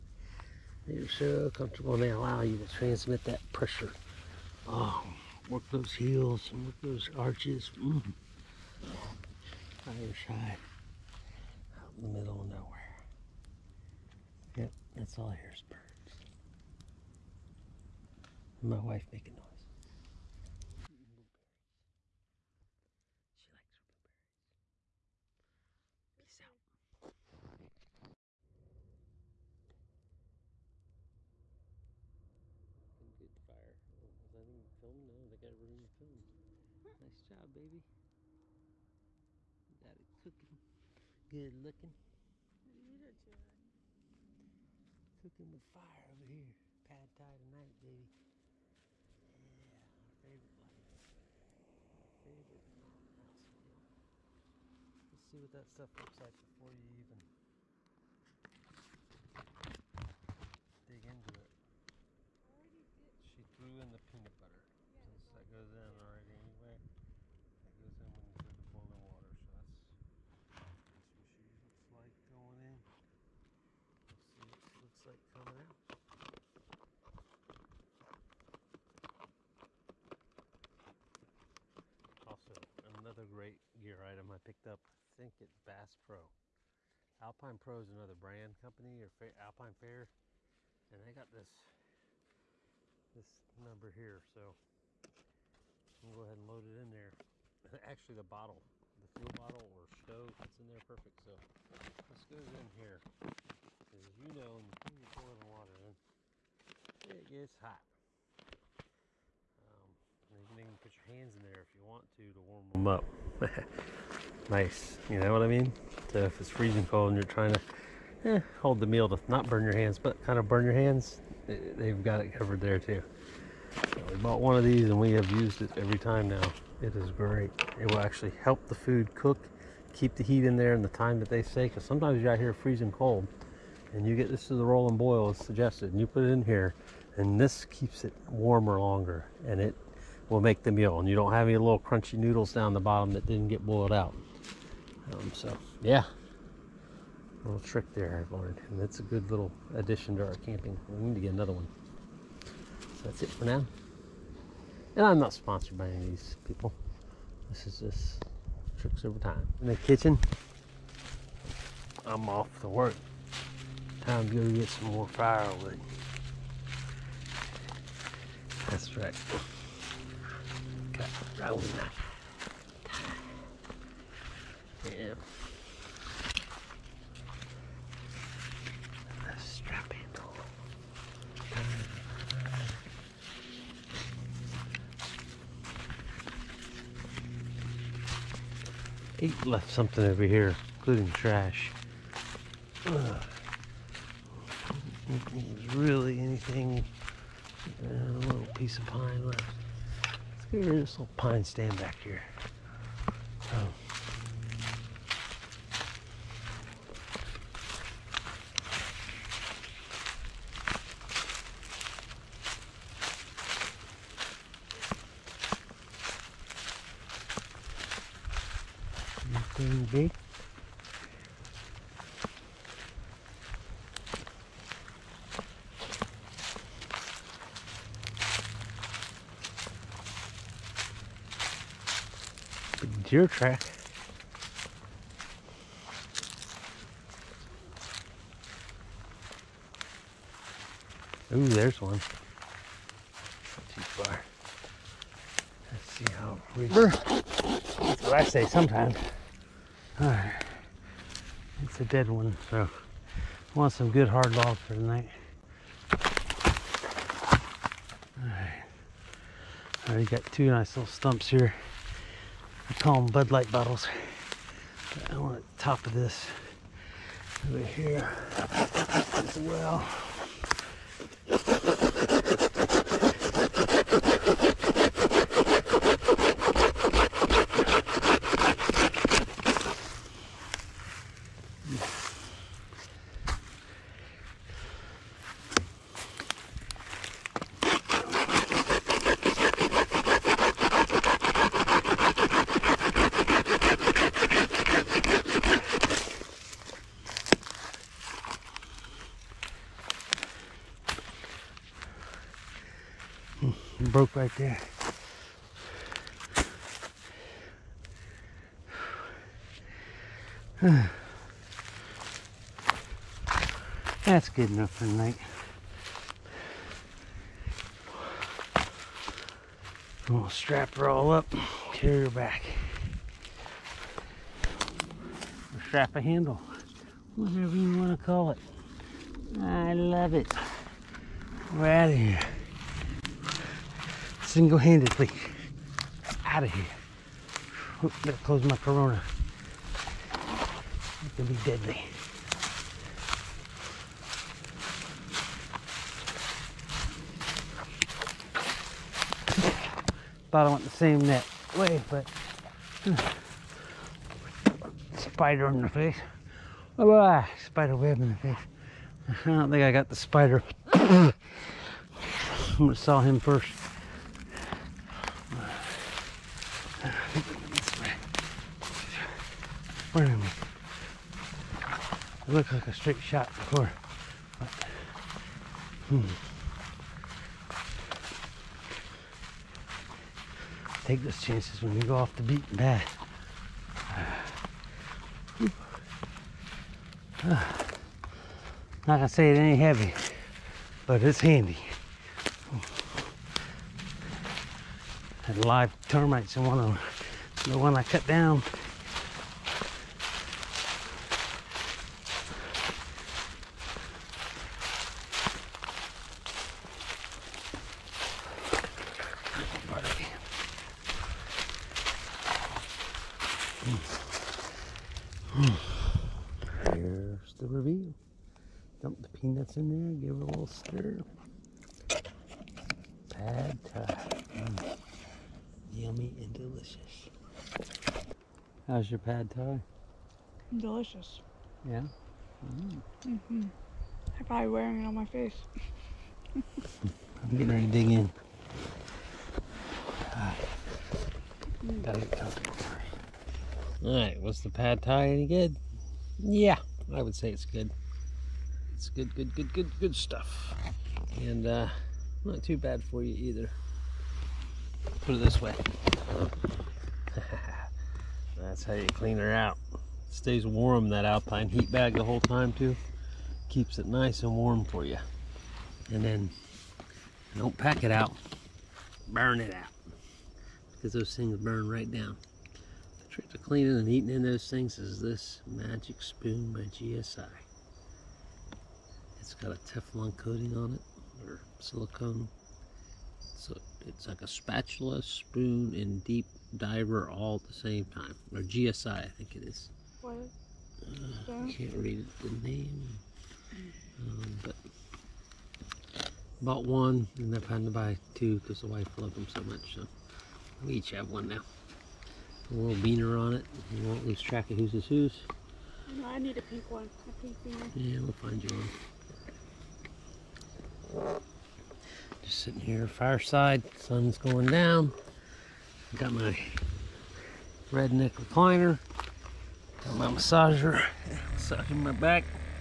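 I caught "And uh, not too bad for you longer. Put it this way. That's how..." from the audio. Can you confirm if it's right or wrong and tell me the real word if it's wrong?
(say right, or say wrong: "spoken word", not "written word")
wrong: "either", not "longer".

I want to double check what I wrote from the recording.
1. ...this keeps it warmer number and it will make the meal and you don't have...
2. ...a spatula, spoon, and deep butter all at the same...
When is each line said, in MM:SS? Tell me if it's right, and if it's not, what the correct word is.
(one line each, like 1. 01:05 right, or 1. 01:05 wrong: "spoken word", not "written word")
1. 02:17 wrong: "longer", not "number"
2. 08:04 wrong: "diver", not "butter".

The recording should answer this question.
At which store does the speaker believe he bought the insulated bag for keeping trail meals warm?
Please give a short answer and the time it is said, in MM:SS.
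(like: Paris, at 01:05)
Bass Pro, at 01:25.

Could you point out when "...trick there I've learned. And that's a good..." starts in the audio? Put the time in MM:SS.
02:27.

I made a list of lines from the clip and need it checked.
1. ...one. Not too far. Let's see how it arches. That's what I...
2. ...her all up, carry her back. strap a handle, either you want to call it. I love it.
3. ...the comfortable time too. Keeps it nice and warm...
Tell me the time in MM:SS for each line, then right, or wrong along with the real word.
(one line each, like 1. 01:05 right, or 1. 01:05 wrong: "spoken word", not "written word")
1. 04:01 wrong: "reaches", not "arches"
2. 05:20 wrong: "whatever", not "either"
3. 07:41 wrong: "whole", not "comfortable".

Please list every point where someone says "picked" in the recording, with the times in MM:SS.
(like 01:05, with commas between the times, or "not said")
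01:24.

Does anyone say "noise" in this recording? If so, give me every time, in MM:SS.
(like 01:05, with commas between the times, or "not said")
00:19.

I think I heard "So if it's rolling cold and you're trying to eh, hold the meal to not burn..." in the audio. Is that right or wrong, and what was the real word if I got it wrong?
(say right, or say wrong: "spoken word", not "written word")
wrong: "freezing", not "rolling".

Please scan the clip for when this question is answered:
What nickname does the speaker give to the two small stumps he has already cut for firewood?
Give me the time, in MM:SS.
04:23.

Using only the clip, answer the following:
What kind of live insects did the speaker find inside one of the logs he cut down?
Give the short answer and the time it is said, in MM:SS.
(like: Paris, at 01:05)
Termites, at 06:35.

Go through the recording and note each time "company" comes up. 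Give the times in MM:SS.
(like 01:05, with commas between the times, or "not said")
01:28.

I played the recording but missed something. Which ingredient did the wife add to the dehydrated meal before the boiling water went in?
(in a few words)
Peanut butter.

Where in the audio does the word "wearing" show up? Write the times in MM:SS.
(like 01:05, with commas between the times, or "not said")
07:14.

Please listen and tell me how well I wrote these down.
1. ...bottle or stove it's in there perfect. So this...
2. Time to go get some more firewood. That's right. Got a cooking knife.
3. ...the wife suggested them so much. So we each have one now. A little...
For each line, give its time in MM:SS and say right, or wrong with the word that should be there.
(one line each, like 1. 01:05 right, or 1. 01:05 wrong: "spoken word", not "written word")
1. 01:39 right
2. 02:44 wrong: "rolling", not "cooking"
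3. 08:18 wrong: "loved", not "suggested".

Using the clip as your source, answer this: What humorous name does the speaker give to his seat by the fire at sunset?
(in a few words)
Redneck recliner.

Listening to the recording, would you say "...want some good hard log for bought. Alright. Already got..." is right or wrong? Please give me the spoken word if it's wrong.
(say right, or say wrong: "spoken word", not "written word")
wrong: "tonight", not "bought".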